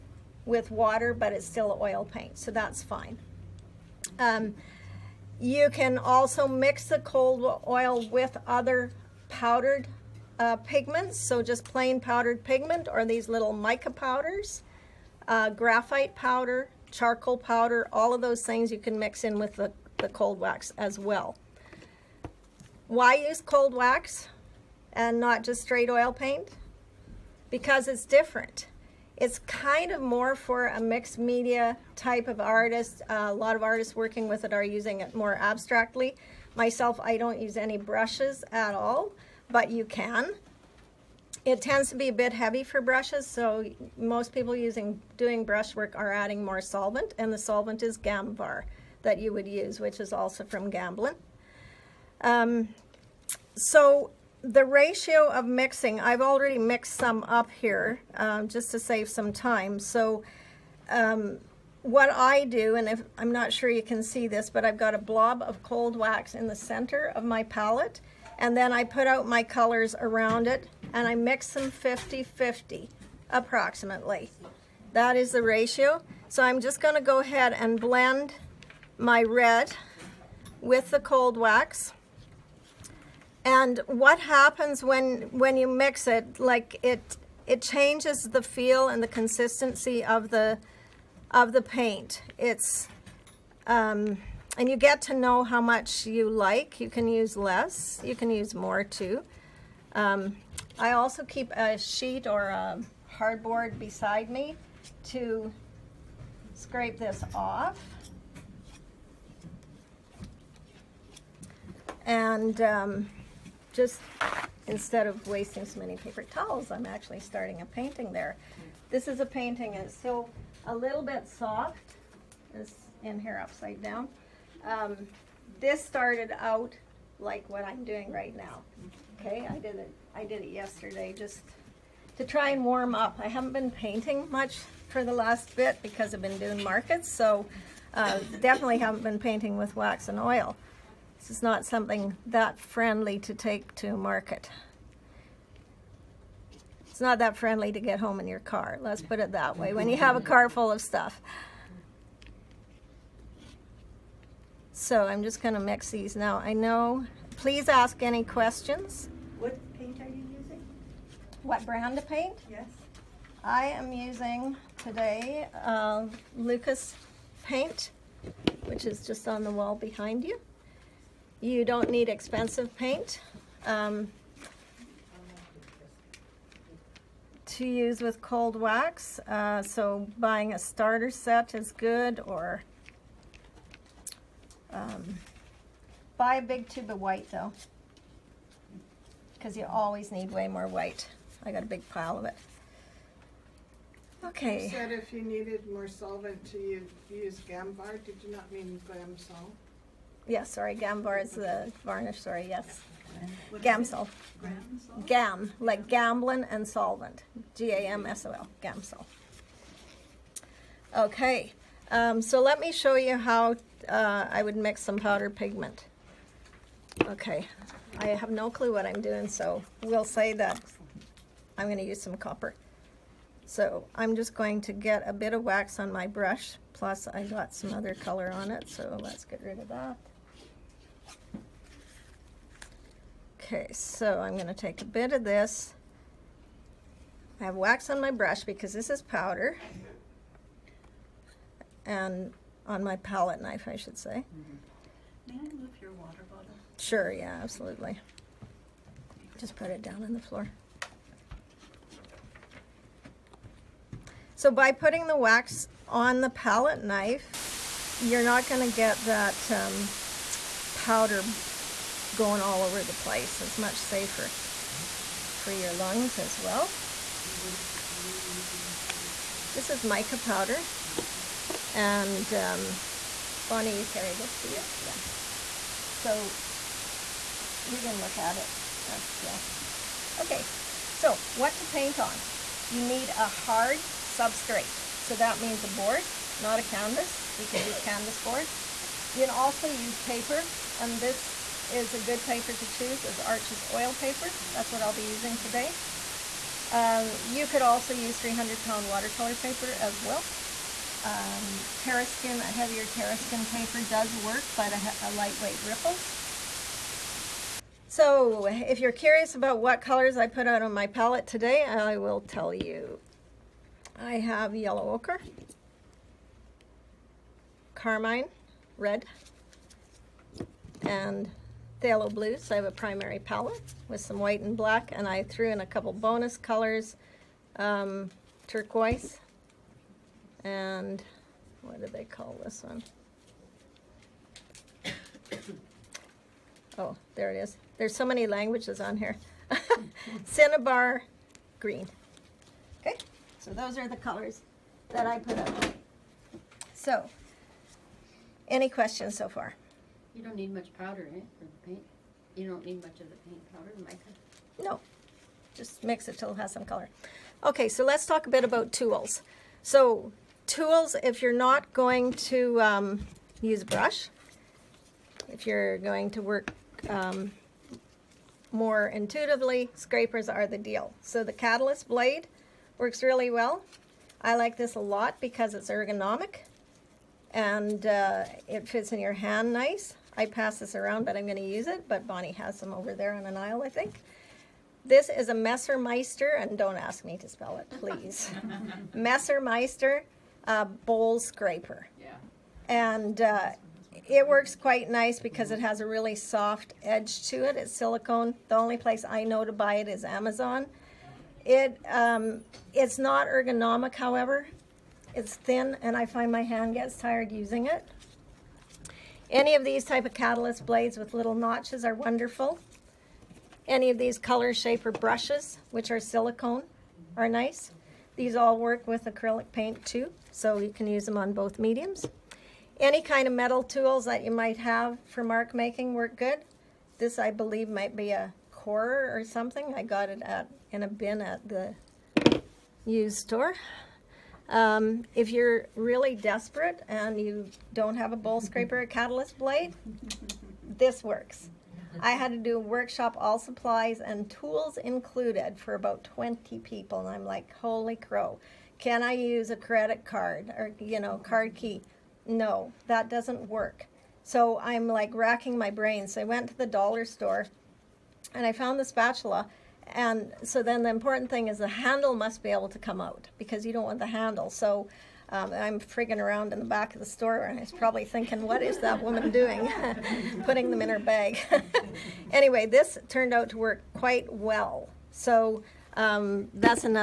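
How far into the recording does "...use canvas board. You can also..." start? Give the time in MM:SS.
04:47.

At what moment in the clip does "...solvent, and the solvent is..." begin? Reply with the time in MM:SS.
00:46.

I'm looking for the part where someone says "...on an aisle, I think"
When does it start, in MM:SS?
06:23.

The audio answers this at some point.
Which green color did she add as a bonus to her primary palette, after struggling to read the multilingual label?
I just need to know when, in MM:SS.
05:40.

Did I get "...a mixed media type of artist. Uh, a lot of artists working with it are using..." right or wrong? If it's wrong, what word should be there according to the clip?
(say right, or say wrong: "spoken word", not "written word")
right.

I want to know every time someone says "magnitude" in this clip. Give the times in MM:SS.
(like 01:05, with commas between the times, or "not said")
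not said.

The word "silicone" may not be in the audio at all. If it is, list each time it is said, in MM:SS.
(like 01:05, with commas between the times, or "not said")
06:37, 06:56.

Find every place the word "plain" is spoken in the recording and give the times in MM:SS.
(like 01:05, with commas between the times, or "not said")
00:11.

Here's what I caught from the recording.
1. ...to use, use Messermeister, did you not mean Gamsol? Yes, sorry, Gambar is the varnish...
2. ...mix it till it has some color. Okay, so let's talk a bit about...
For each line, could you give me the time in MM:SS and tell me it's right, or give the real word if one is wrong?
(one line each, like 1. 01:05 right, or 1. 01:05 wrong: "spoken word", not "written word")
1. 03:16 wrong: "Gambar", not "Messermeister"
2. 05:55 right.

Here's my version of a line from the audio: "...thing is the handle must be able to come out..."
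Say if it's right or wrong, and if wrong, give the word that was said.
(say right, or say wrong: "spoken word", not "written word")
right.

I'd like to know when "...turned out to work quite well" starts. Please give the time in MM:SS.
07:53.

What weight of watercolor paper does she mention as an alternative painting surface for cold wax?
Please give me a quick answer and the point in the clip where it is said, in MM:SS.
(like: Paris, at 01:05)
300 pound, at 04:58.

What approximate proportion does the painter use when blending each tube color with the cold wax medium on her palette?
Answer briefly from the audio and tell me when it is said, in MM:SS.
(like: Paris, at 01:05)
50-50, at 01:11.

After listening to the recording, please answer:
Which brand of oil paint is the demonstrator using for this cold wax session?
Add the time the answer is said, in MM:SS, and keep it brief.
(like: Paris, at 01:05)
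Lukas, at 02:46.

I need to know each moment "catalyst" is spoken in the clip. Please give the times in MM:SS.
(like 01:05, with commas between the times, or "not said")
06:11, 06:50, 07:18.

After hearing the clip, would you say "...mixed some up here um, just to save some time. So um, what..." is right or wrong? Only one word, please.
right.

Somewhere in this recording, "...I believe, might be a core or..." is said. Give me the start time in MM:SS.
07:07.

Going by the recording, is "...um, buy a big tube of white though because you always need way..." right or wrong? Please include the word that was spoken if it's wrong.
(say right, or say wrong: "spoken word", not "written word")
right.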